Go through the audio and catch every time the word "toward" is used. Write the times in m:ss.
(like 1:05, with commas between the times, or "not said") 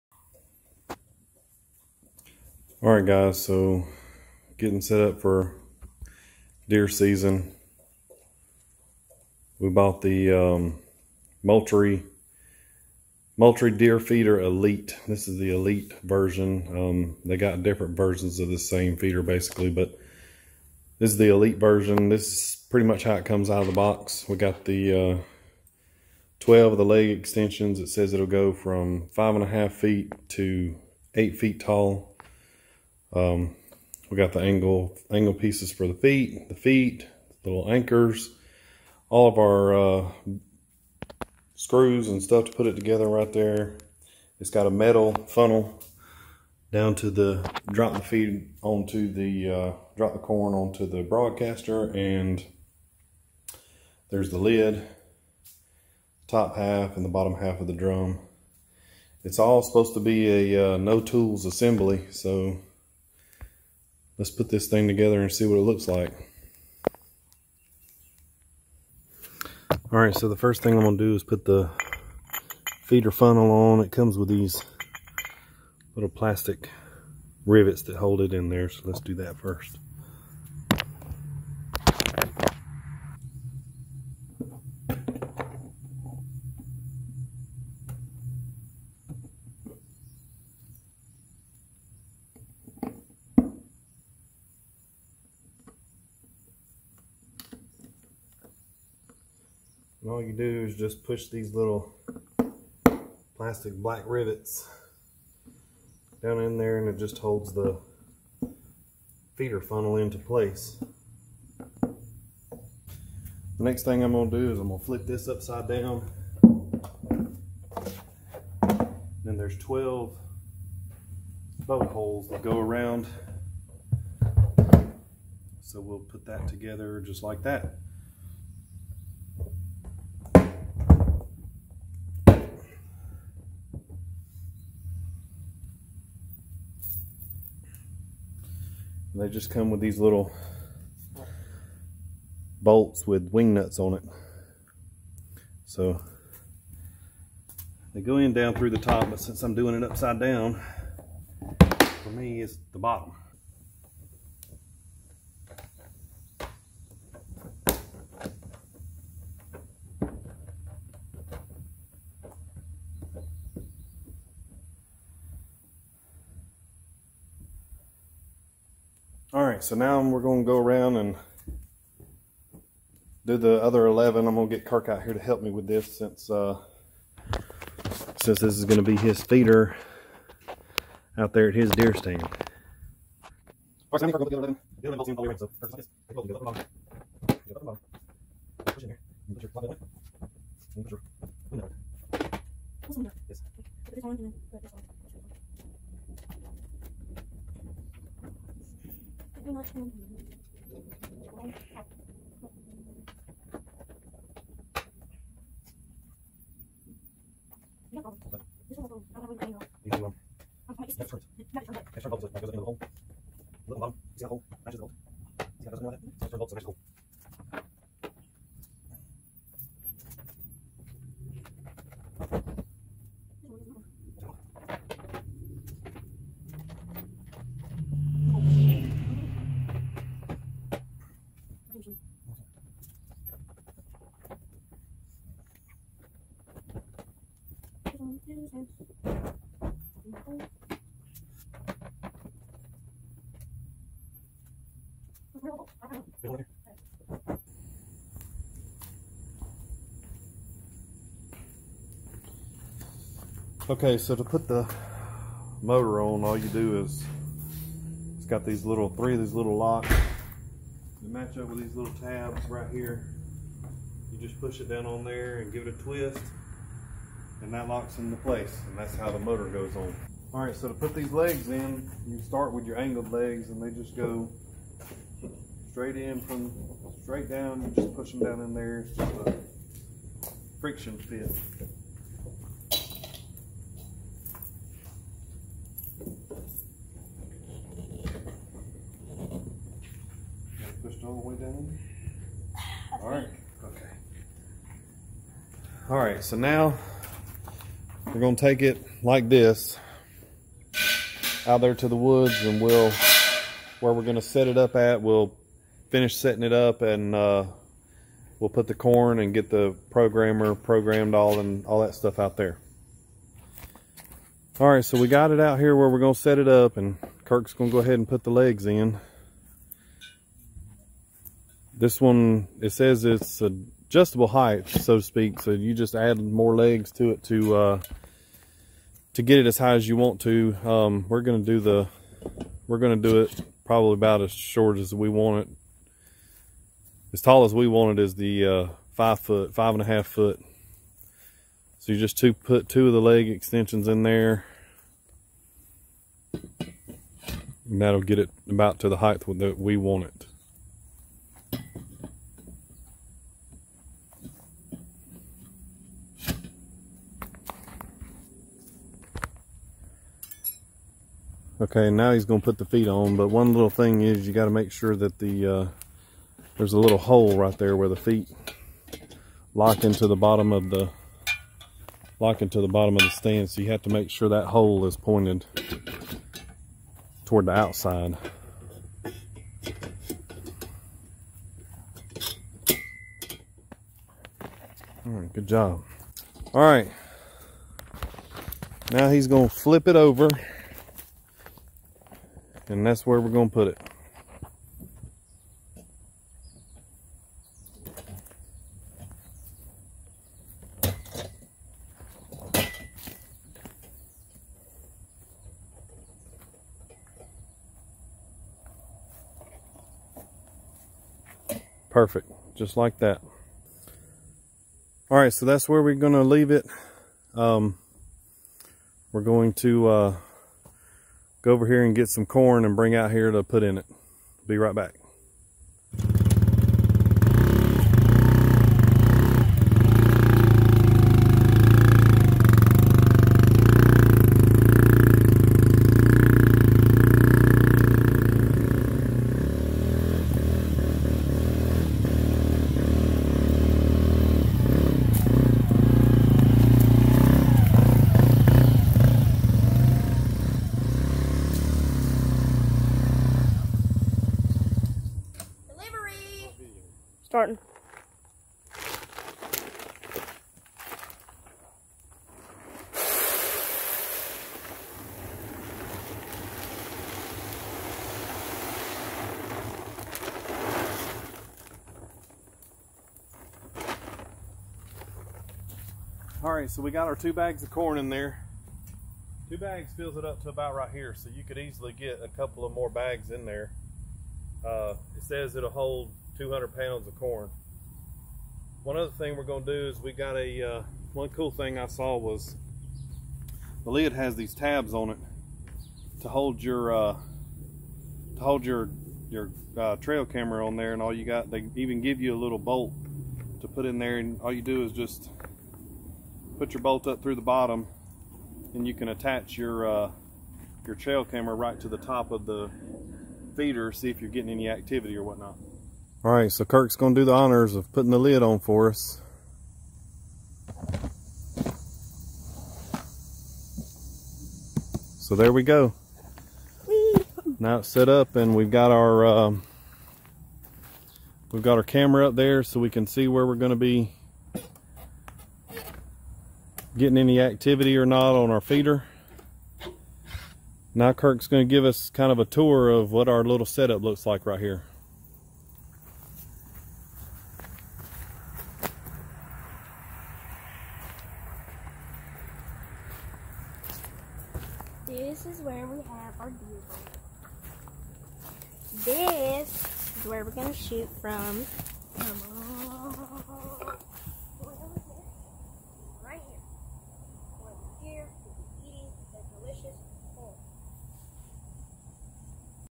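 6:17.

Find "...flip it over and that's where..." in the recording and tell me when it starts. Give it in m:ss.
6:29.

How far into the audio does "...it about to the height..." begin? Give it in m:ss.
5:48.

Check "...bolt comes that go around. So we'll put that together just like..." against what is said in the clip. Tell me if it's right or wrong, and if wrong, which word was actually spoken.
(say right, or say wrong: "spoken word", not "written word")
wrong: "holes", not "comes".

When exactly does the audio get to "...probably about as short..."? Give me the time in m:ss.
5:33.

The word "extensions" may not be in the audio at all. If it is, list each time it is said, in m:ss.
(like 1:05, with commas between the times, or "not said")
0:27, 5:43.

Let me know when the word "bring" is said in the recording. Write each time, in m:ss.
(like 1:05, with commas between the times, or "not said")
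7:02.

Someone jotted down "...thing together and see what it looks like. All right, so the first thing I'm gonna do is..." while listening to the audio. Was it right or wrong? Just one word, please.
right.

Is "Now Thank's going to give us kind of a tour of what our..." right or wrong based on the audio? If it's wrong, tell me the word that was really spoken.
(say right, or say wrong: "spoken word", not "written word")
wrong: "Kirk", not "Thank".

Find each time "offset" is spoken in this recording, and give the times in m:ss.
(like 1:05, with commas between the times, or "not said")
not said.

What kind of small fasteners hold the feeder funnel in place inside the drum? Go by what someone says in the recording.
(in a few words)
plastic rivets.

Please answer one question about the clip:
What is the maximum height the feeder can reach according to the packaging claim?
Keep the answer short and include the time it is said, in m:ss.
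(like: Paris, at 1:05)
8 feet, at 0:31.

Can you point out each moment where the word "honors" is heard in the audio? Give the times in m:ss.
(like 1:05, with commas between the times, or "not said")
8:37.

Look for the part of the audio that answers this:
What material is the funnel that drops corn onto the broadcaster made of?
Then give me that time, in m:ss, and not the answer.
0:44.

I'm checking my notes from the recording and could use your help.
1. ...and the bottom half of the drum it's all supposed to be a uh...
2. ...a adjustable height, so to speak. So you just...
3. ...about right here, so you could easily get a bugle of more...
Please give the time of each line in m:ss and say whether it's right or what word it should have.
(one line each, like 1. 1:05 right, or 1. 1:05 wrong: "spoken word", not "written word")
1. 0:56 right
2. 5:23 right
3. 8:00 wrong: "couple", not "bugle".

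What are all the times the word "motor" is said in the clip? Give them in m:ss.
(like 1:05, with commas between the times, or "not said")
4:15, 4:29.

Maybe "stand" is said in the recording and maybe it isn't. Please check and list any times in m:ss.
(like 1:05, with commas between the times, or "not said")
3:01, 6:13.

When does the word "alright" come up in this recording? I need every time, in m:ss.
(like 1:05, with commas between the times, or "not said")
not said.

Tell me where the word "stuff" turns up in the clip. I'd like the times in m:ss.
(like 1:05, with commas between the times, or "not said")
0:42, 5:11.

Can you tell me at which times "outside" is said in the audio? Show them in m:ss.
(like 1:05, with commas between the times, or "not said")
6:17.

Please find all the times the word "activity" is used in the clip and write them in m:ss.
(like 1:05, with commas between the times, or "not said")
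8:34, 8:57.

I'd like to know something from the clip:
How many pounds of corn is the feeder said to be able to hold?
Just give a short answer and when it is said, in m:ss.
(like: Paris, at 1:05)
200, at 8:06.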